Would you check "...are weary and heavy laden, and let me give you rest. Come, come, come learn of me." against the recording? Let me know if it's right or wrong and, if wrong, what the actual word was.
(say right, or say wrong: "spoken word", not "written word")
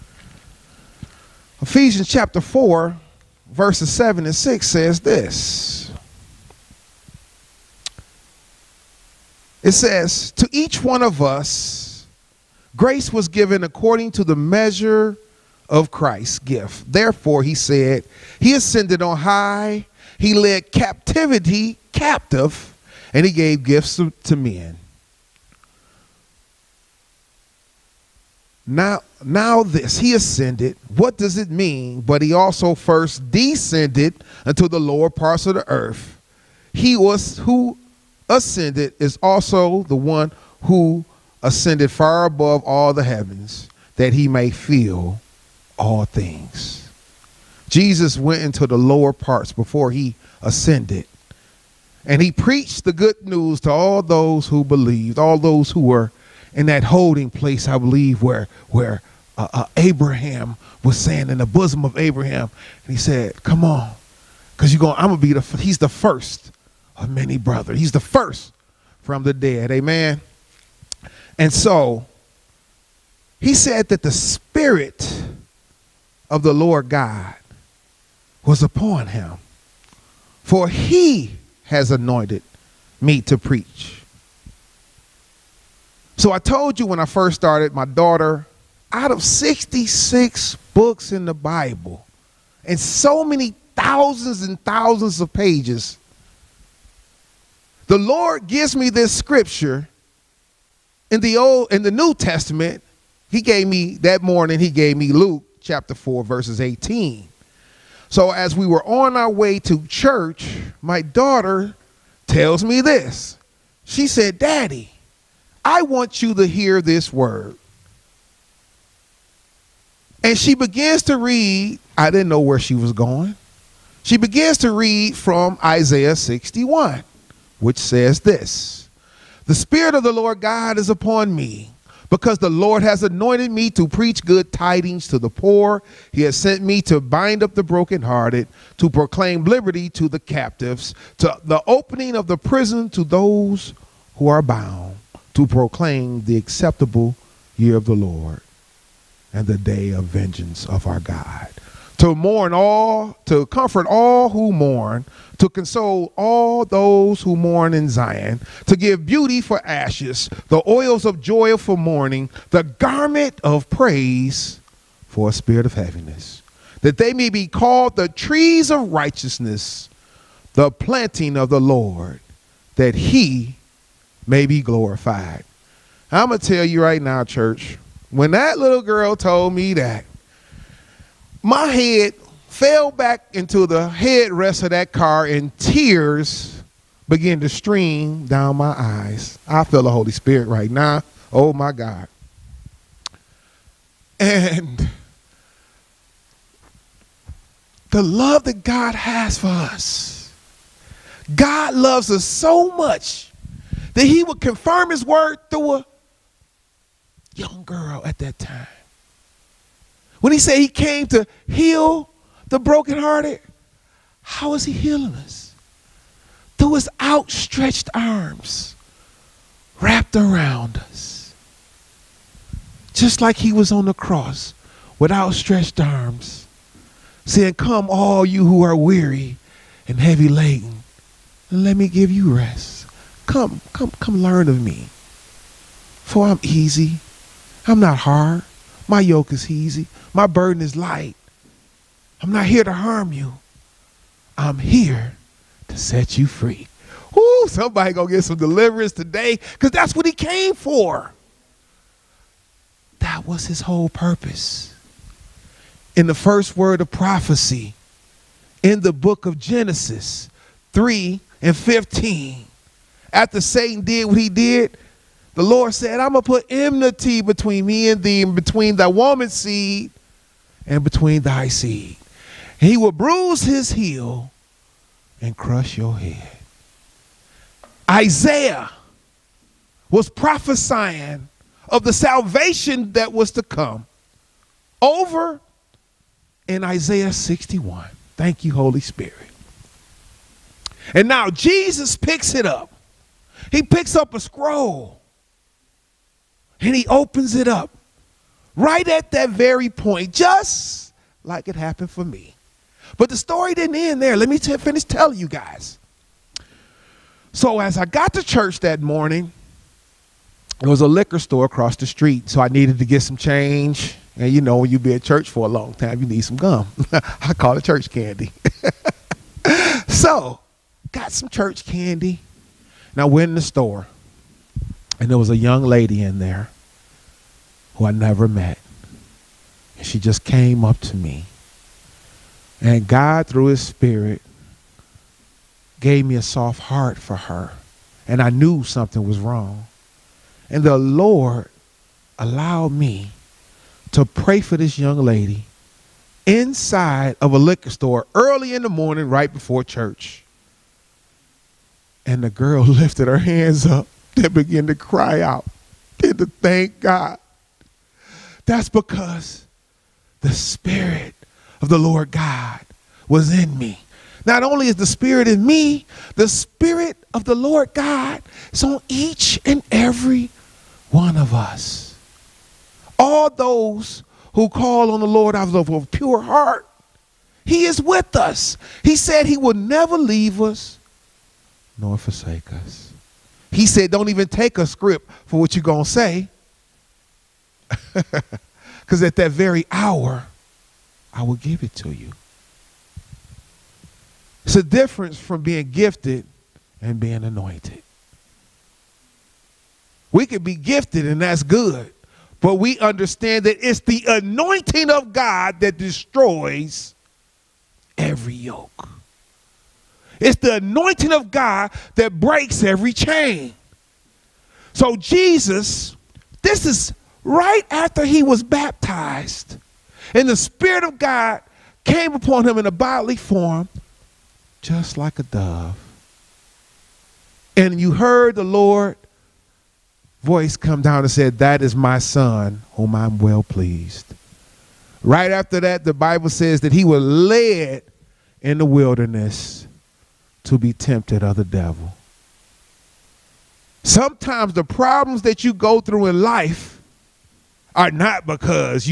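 right.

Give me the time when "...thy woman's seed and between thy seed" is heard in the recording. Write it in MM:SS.
04:28.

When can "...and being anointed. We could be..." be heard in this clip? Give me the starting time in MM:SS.
06:36.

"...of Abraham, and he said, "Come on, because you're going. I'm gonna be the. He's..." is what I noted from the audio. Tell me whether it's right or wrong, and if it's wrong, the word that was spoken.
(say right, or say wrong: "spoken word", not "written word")
right.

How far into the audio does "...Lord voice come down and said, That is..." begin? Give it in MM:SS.
07:08.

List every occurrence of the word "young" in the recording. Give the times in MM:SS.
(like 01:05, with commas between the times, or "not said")
03:27, 05:25, 05:44.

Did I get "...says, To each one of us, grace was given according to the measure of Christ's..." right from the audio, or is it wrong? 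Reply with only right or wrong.
right.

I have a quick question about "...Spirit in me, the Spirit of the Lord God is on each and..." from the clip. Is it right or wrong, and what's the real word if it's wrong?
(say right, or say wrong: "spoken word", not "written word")
right.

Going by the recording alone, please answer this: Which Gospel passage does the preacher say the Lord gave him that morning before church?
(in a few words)
Luke chapter 4 verses 18.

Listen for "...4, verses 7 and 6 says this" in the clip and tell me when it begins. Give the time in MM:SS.
00:02.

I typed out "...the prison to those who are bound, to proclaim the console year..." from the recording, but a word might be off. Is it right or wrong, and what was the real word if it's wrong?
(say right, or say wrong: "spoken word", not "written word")
wrong: "acceptable", not "console".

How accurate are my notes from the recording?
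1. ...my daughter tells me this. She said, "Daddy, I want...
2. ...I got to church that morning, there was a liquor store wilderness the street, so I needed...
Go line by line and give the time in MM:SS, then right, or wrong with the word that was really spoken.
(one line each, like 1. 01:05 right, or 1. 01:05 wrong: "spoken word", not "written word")
1. 01:50 right
2. 05:07 wrong: "across", not "wilderness".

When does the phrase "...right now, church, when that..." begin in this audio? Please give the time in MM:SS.
02:56.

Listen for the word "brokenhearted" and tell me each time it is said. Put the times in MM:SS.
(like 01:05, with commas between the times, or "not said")
02:17, 03:32.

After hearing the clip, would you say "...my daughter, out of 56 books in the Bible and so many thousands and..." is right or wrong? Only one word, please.
wrong.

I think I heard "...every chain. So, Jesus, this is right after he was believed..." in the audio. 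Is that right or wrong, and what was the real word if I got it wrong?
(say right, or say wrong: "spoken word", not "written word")
wrong: "baptized", not "believed".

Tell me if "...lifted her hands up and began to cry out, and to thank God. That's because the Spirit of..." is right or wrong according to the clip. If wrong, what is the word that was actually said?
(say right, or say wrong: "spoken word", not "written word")
right.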